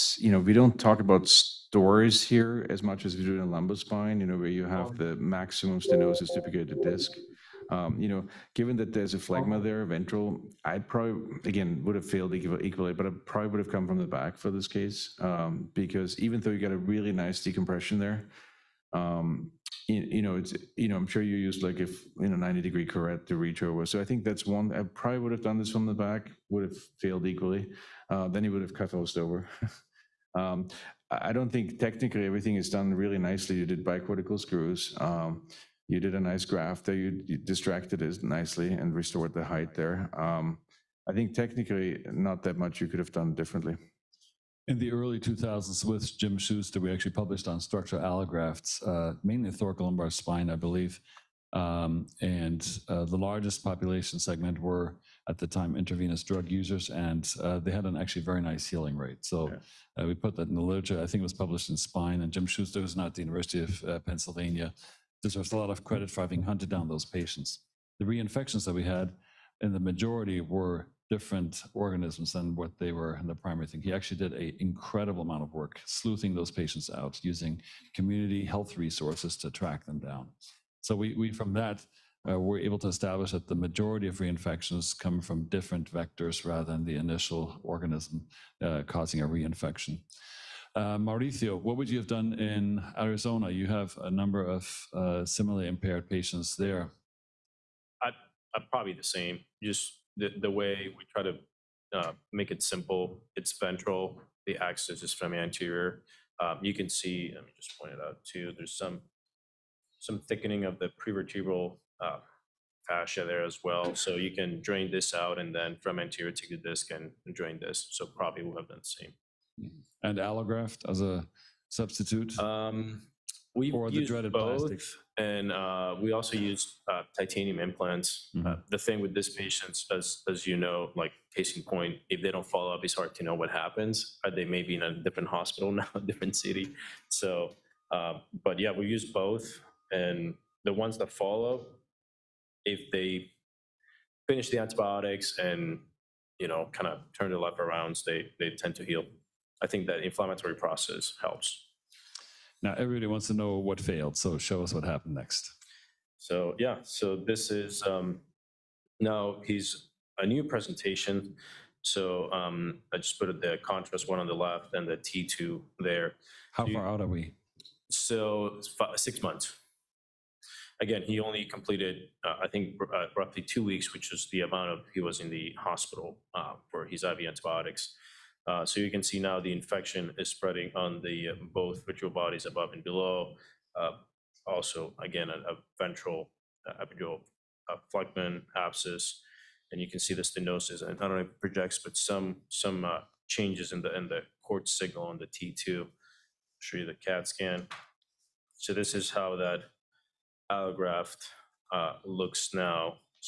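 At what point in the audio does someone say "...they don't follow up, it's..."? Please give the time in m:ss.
2:12.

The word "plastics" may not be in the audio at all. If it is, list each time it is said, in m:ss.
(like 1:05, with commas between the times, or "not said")
2:04.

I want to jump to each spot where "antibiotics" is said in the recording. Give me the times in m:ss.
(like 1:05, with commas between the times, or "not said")
2:24, 2:57.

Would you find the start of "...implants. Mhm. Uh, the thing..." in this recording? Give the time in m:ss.
2:07.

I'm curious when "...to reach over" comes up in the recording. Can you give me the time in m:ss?
0:23.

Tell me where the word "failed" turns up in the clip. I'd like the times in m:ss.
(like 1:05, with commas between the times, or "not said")
0:12, 0:26, 2:33.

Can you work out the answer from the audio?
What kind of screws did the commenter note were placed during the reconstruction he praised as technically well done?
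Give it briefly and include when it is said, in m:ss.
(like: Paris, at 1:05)
Bicortical screws, at 0:33.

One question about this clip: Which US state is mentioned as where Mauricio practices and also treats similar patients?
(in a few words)
Arizona.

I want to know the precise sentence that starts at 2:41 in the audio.
So um, I just put the contrast one on the left and the T2 there.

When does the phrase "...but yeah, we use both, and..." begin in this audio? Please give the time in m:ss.
2:18.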